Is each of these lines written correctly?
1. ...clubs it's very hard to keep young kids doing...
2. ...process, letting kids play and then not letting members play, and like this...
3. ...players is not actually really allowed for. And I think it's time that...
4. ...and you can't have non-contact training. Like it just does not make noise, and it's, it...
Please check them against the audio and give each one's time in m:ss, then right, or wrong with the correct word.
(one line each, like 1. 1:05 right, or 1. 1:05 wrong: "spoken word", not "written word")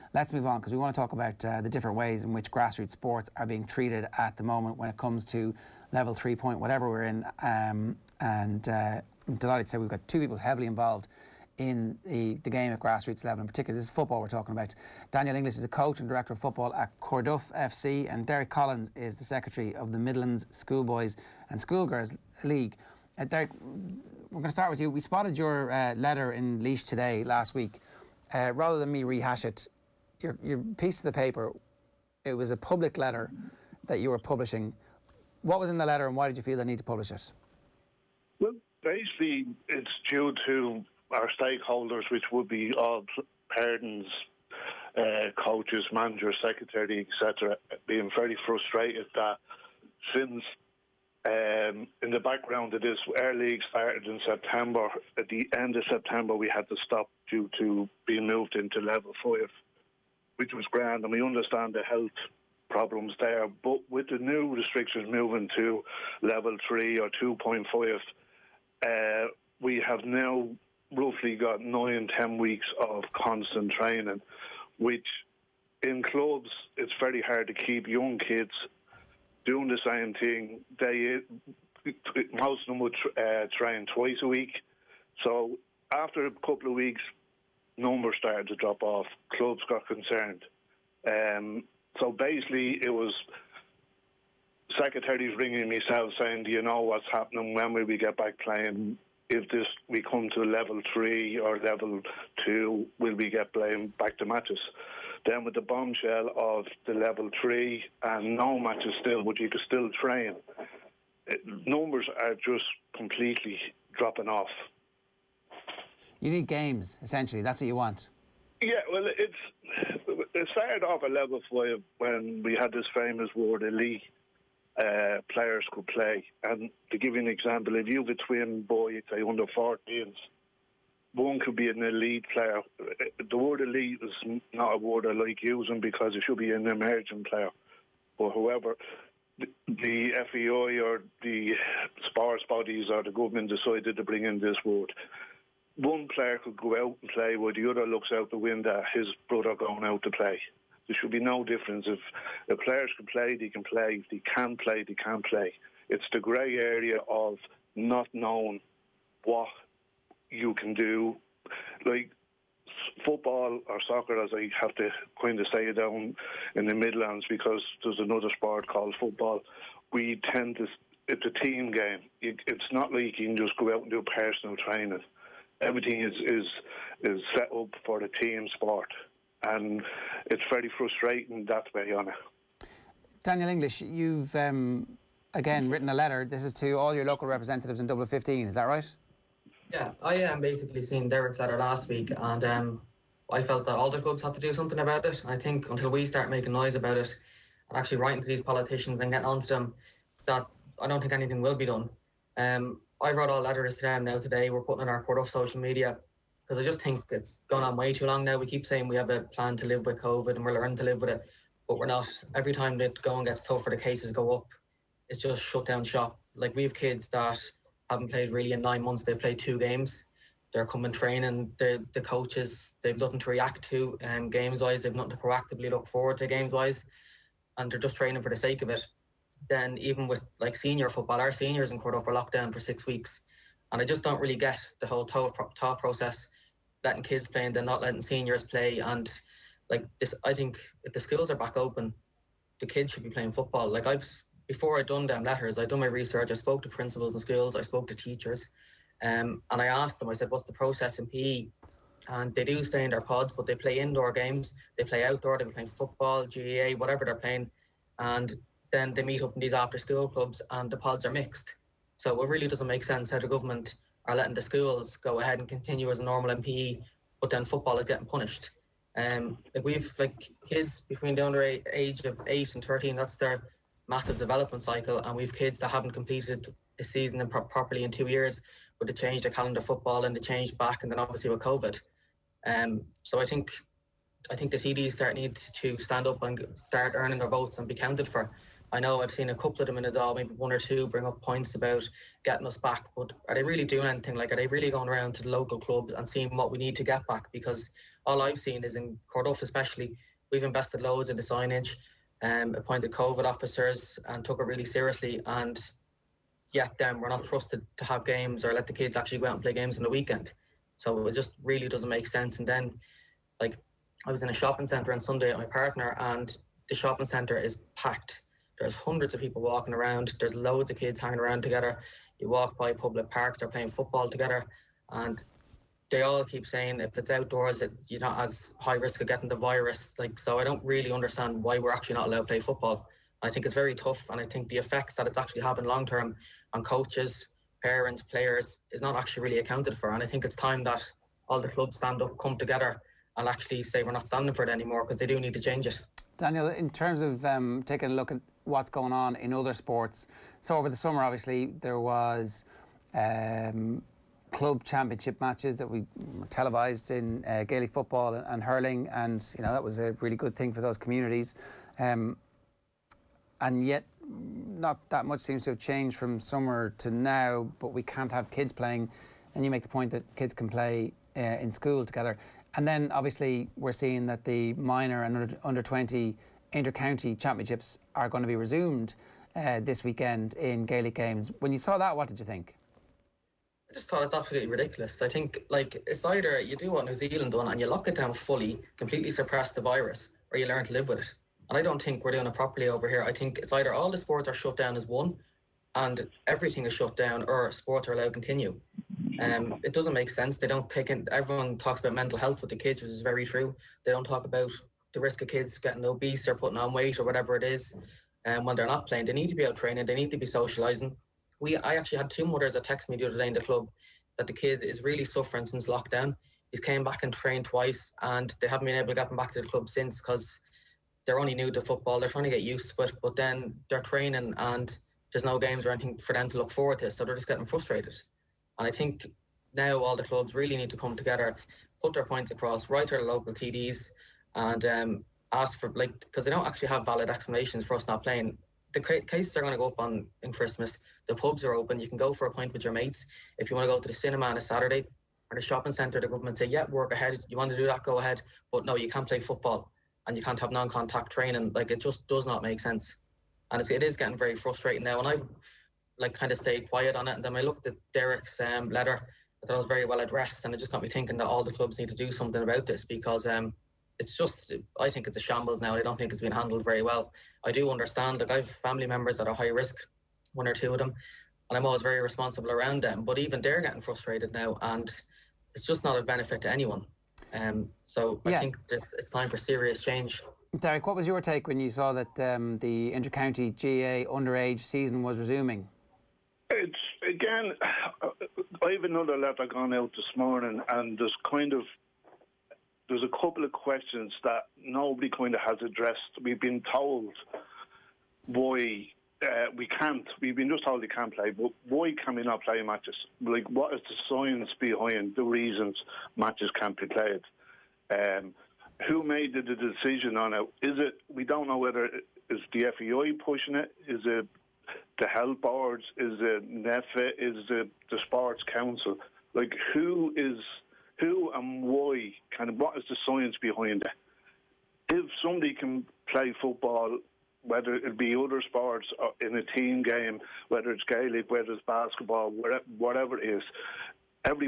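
1. 1:16 right
2. 3:55 wrong: "seniors", not "members"
3. 5:38 wrong: "accounted", not "allowed"
4. 7:30 wrong: "sense", not "noise".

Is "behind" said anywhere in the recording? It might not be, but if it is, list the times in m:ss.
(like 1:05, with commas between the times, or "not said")
8:24, 8:43.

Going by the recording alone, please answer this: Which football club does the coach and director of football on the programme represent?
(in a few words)
Corduff FC.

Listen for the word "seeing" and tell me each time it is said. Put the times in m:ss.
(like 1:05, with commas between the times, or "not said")
3:10, 4:56, 6:13.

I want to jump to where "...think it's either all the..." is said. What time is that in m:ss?
6:33.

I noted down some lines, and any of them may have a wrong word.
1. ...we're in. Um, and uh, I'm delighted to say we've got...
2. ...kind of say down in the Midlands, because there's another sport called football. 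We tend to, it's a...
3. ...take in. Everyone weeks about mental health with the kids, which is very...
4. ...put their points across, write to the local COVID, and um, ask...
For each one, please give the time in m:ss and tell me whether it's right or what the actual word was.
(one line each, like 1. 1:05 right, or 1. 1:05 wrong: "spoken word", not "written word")
1. 0:06 right
2. 2:45 right
3. 6:40 wrong: "talks", not "weeks"
4. 7:11 wrong: "TDs", not "COVID".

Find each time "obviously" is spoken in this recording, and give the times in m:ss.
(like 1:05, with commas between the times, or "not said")
4:40, 5:51, 6:12.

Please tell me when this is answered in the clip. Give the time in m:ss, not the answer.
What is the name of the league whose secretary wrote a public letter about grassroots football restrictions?
0:19.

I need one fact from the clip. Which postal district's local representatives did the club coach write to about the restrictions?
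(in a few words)
Dublin 15.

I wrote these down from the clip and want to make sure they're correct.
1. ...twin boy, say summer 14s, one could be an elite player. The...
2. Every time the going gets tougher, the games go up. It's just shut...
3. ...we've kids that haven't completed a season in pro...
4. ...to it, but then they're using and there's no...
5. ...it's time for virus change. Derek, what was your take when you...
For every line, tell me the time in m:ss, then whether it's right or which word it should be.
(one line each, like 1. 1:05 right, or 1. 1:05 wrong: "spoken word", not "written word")
1. 2:08 wrong: "under", not "summer"
2. 3:32 wrong: "cases", not "games"
3. 4:35 right
4. 7:02 wrong: "training", not "using"
5. 7:58 wrong: "serious", not "virus".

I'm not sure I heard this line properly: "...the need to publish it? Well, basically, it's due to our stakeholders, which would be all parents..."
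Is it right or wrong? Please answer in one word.
right.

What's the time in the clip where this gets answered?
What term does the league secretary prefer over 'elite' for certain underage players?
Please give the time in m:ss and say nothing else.
2:16.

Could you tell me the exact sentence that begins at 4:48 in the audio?
I know I've seen a couple of them in the Dáil, maybe one or two, bring up points about getting us back.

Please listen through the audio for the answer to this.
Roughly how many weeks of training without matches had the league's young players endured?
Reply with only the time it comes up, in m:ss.
1:11.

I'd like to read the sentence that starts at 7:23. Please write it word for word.
If you want to go to the cinema on a Saturday or the shopping centre, the government say, "Yeah, work ahead.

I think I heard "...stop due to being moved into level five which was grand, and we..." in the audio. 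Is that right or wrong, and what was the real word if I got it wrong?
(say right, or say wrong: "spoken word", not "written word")
right.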